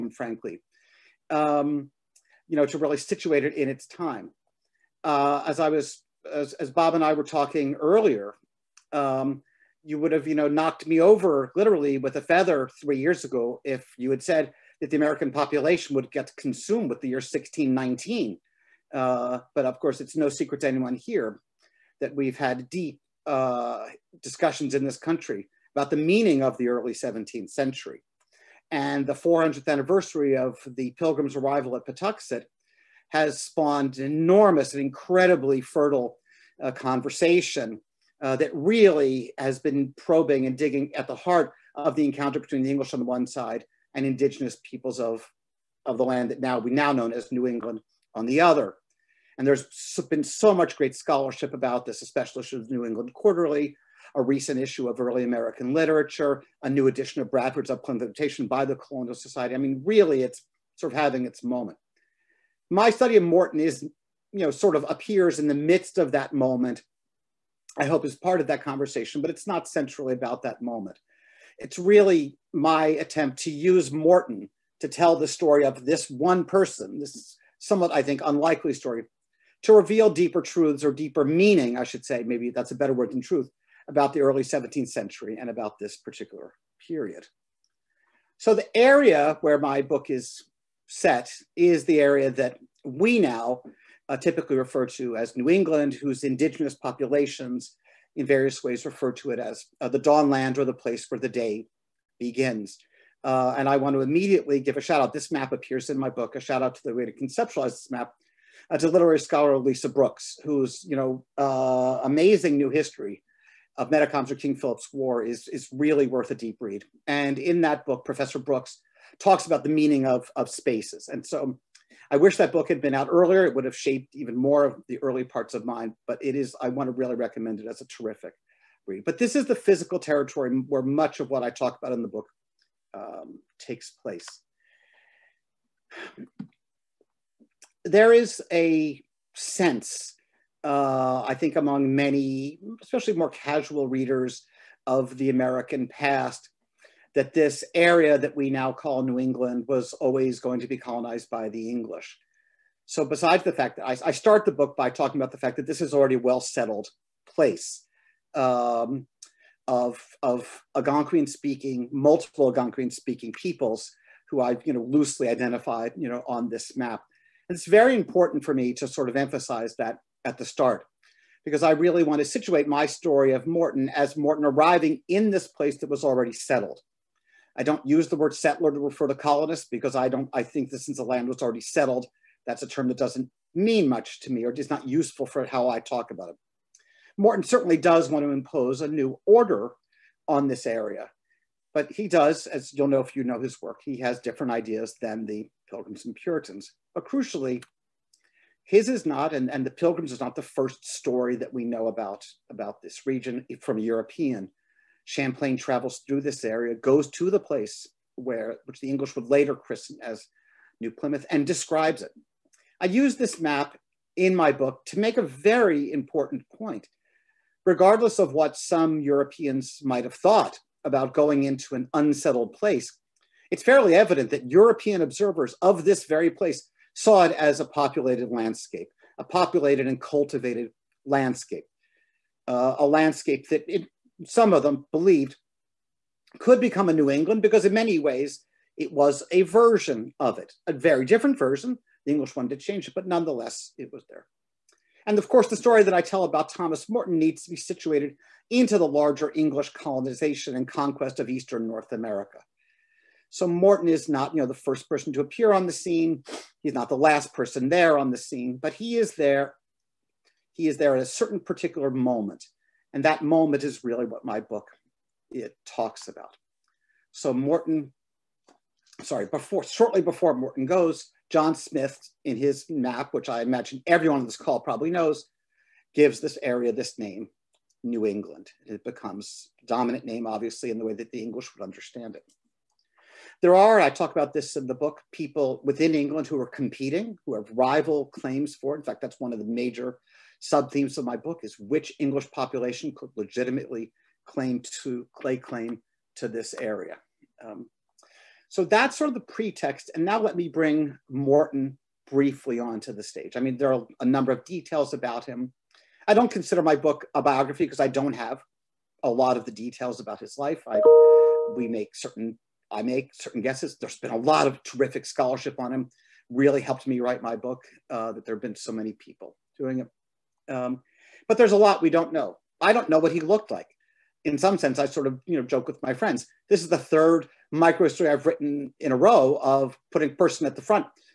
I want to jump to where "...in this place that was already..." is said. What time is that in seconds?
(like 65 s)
175 s.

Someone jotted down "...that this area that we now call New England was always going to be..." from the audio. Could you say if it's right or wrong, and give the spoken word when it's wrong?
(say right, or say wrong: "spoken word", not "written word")
right.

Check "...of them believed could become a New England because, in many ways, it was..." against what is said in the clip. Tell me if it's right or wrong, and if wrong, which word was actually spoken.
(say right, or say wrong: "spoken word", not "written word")
right.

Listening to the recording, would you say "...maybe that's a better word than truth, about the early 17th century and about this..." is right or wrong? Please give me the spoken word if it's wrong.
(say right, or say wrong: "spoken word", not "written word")
right.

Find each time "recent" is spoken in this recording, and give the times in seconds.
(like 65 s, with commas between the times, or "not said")
54 s.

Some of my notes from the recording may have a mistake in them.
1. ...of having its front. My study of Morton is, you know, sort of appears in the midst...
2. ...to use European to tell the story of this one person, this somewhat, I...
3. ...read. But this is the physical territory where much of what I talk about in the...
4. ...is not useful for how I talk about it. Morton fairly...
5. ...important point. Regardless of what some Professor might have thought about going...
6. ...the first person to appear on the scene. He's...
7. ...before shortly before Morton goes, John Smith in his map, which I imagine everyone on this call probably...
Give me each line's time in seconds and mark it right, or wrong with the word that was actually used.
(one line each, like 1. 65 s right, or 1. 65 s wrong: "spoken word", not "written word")
1. 60 s wrong: "moment", not "front"
2. 73 s wrong: "Morton", not "European"
3. 128 s right
4. 184 s wrong: "certainly", not "fairly"
5. 215 s wrong: "Europeans", not "Professor"
6. 254 s right
7. 269 s right.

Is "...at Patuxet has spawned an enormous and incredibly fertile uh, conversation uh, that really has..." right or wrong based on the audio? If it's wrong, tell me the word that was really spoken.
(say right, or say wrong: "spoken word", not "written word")
right.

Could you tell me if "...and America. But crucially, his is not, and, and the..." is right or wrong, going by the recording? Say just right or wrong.
wrong.